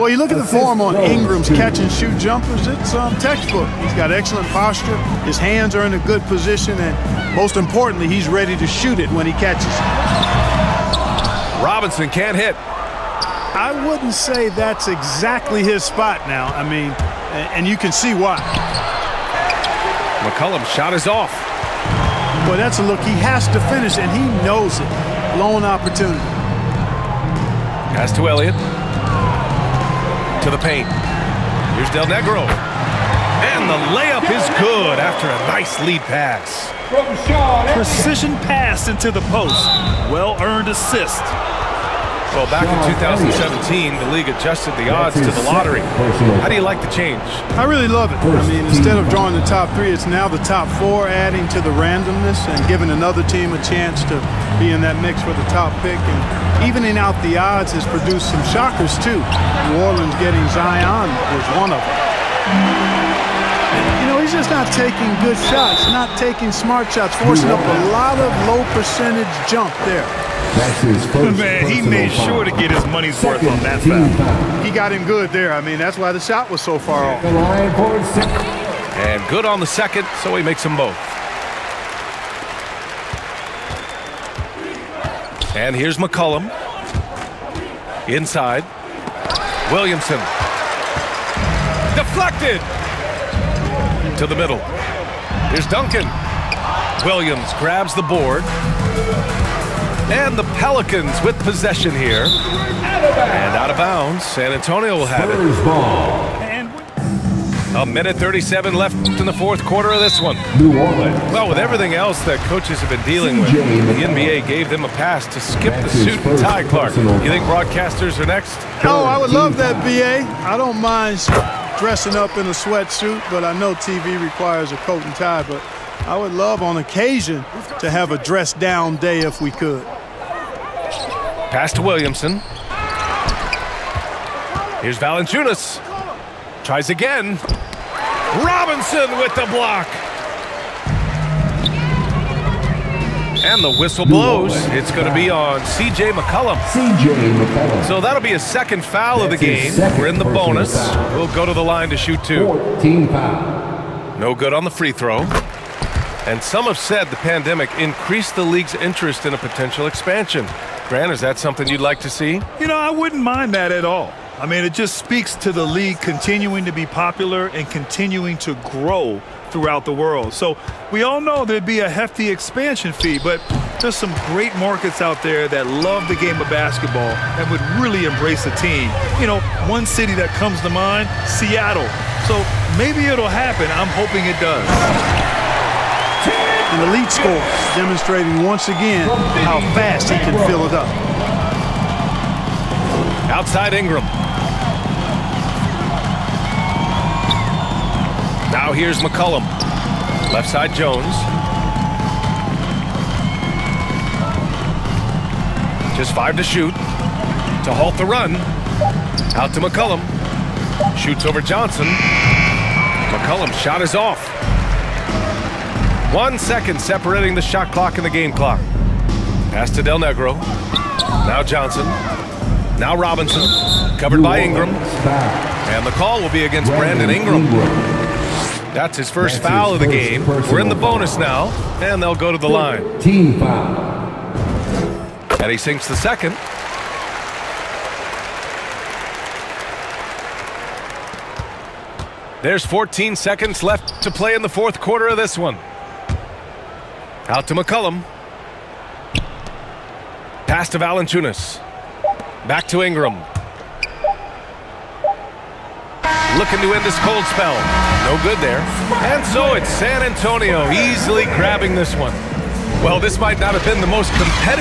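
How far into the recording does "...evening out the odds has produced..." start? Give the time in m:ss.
0:56.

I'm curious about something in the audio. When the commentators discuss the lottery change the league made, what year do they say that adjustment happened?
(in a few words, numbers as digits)
2017.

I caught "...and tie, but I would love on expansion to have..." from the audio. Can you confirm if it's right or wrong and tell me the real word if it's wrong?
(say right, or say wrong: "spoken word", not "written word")
wrong: "occasion", not "expansion".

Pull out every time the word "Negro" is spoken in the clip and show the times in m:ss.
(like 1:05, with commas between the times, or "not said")
0:32, 3:40.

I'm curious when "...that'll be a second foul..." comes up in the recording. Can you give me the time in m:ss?
2:28.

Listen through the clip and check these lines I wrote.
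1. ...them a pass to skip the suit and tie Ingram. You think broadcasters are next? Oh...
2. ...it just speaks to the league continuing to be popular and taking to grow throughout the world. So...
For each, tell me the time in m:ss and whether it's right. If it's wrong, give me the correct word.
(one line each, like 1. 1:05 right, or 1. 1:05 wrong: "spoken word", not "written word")
1. 1:54 wrong: "Clark", not "Ingram"
2. 2:44 wrong: "continuing", not "taking".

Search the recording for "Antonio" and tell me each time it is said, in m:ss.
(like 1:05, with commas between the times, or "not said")
1:44, 4:20.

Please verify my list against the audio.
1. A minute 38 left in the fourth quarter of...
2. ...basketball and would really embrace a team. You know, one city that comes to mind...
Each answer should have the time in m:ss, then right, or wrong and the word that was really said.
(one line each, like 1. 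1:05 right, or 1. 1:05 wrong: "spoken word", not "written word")
1. 1:47 wrong: "37", not "38"
2. 2:56 right.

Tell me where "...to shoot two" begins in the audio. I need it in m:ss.
2:31.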